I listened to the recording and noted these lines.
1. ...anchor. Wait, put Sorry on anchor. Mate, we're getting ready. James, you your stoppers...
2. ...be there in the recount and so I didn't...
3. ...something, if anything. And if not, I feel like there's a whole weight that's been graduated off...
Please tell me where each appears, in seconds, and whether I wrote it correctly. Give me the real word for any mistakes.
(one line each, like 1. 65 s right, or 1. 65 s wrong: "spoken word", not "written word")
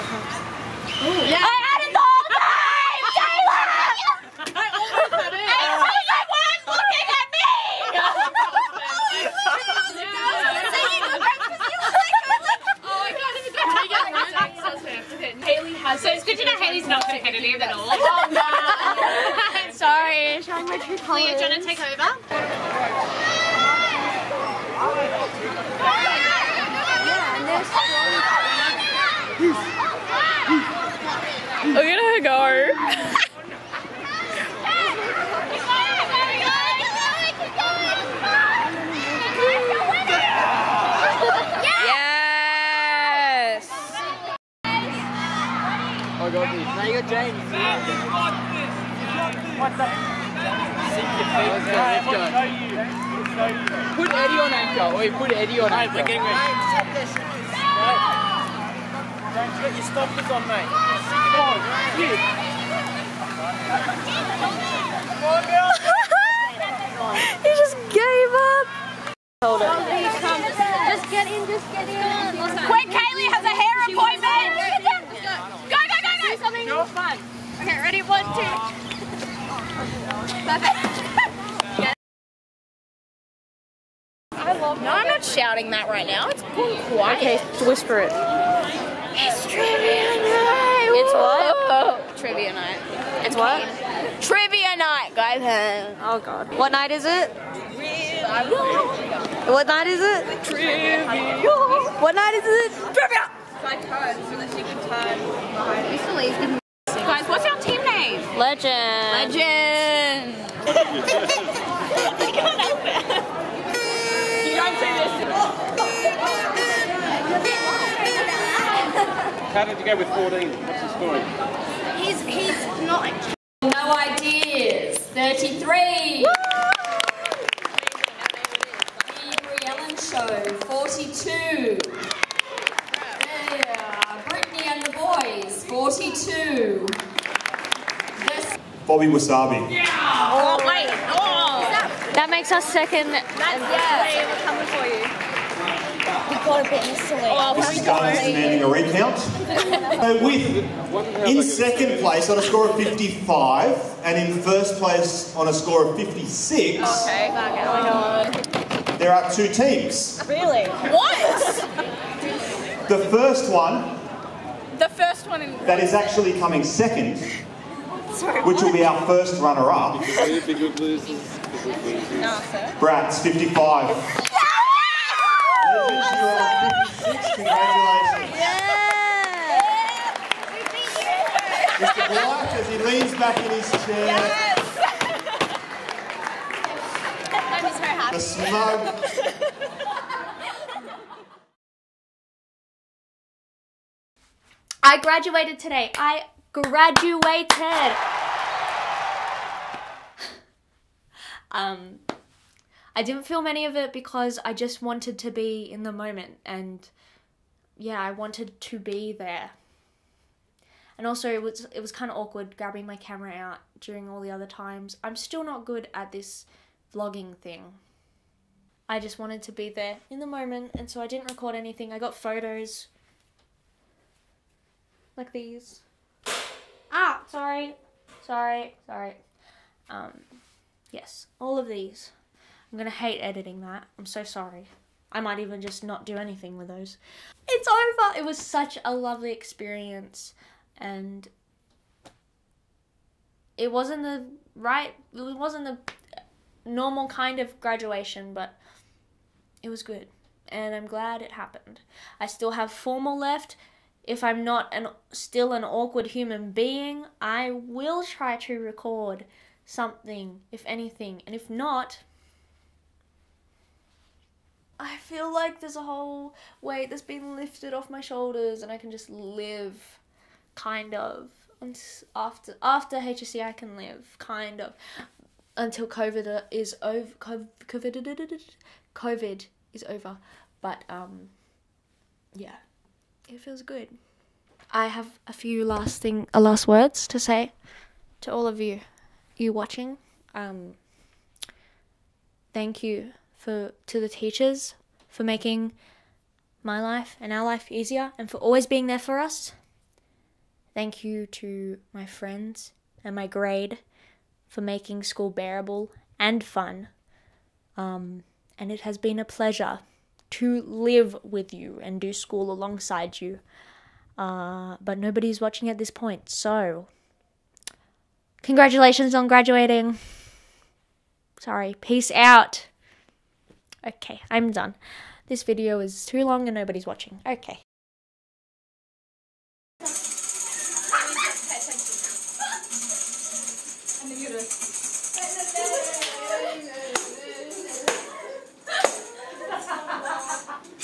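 1. 54 s wrong: "Eddie", not "Sorry"
2. 219 s wrong: "moment", not "recount"
3. 259 s wrong: "lifted", not "graduated".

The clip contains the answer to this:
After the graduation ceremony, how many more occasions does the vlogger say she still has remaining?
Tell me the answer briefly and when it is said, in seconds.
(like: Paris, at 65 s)
4, at 252 s.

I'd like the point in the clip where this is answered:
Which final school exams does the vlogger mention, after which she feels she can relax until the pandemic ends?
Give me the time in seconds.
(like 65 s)
272 s.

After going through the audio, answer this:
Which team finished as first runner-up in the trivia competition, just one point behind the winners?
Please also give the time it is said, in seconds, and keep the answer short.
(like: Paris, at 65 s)
Bratz, at 172 s.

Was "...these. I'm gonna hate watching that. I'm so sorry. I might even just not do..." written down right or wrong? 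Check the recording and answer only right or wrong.
wrong.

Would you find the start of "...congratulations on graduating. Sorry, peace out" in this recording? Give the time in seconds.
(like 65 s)
318 s.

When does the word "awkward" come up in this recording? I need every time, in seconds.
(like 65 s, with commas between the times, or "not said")
212 s, 255 s.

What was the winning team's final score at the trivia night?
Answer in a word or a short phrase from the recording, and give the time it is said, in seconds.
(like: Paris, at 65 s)
56, at 155 s.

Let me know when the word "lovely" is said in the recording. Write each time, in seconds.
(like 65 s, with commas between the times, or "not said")
238 s.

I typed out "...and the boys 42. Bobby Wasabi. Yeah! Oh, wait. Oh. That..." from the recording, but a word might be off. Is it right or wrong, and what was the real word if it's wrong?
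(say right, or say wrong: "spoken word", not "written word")
right.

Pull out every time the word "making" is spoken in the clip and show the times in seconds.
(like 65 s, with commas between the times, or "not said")
295 s, 304 s.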